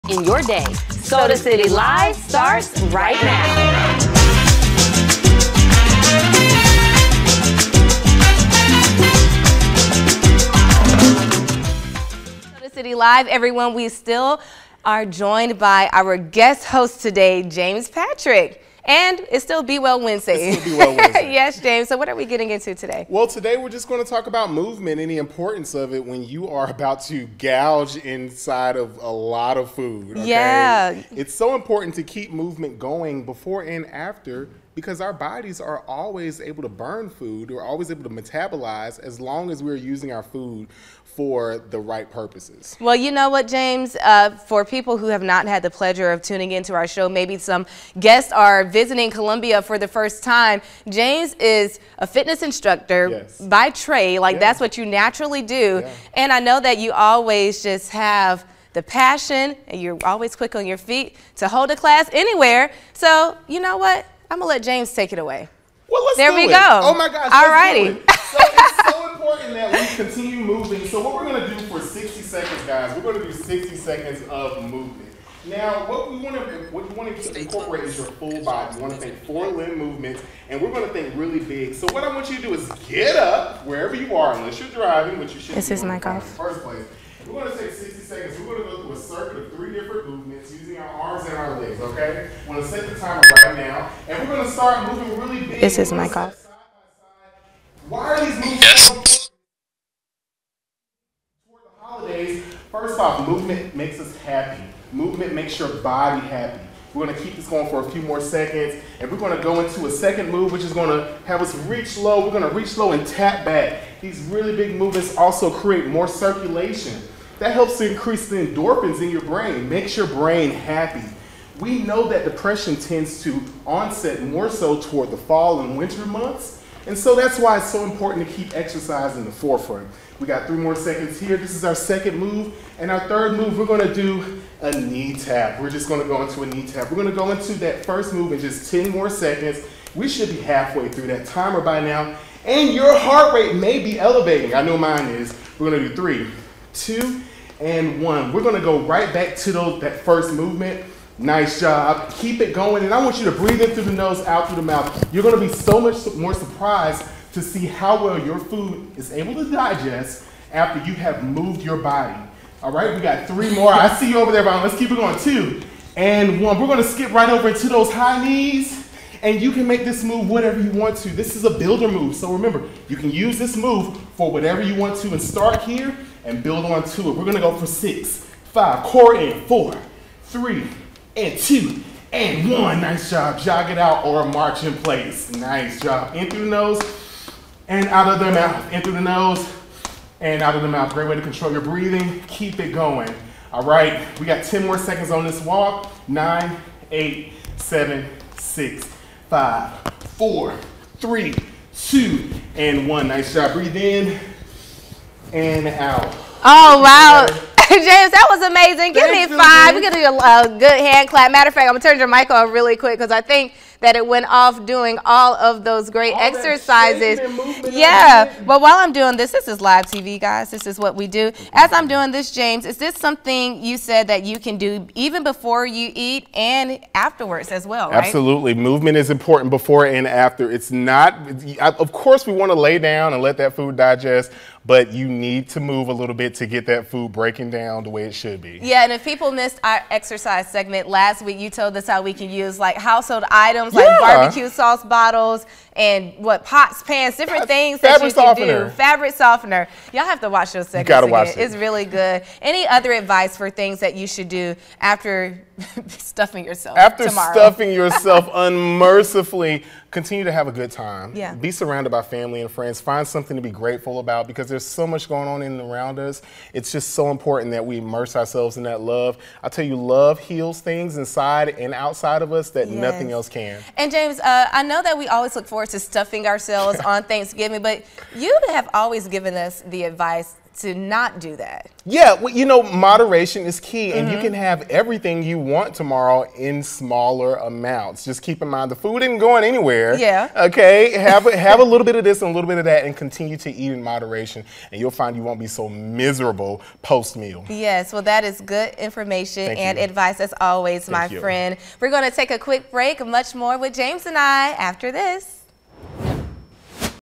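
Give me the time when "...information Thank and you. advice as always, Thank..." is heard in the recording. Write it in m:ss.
4:58.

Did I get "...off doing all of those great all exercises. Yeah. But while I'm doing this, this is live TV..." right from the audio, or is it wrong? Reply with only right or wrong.
right.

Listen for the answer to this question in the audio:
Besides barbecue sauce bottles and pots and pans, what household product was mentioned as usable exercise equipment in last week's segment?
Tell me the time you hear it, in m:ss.
4:08.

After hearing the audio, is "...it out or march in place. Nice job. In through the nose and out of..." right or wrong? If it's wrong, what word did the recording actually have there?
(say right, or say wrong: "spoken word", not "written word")
right.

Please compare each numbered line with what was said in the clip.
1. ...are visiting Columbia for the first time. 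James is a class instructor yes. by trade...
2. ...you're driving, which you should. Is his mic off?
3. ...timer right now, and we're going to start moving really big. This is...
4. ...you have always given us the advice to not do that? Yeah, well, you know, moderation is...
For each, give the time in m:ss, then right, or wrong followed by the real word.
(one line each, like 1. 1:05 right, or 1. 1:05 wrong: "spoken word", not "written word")
1. 0:48 wrong: "fitness", not "class"
2. 1:24 right
3. 1:32 right
4. 4:38 right.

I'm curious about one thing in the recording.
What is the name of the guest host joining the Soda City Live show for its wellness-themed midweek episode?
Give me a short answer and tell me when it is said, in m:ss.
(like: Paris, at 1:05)
James Patrick, at 0:17.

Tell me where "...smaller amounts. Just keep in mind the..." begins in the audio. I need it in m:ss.
4:46.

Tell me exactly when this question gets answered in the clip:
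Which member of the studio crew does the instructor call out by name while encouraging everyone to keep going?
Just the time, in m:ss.
2:44.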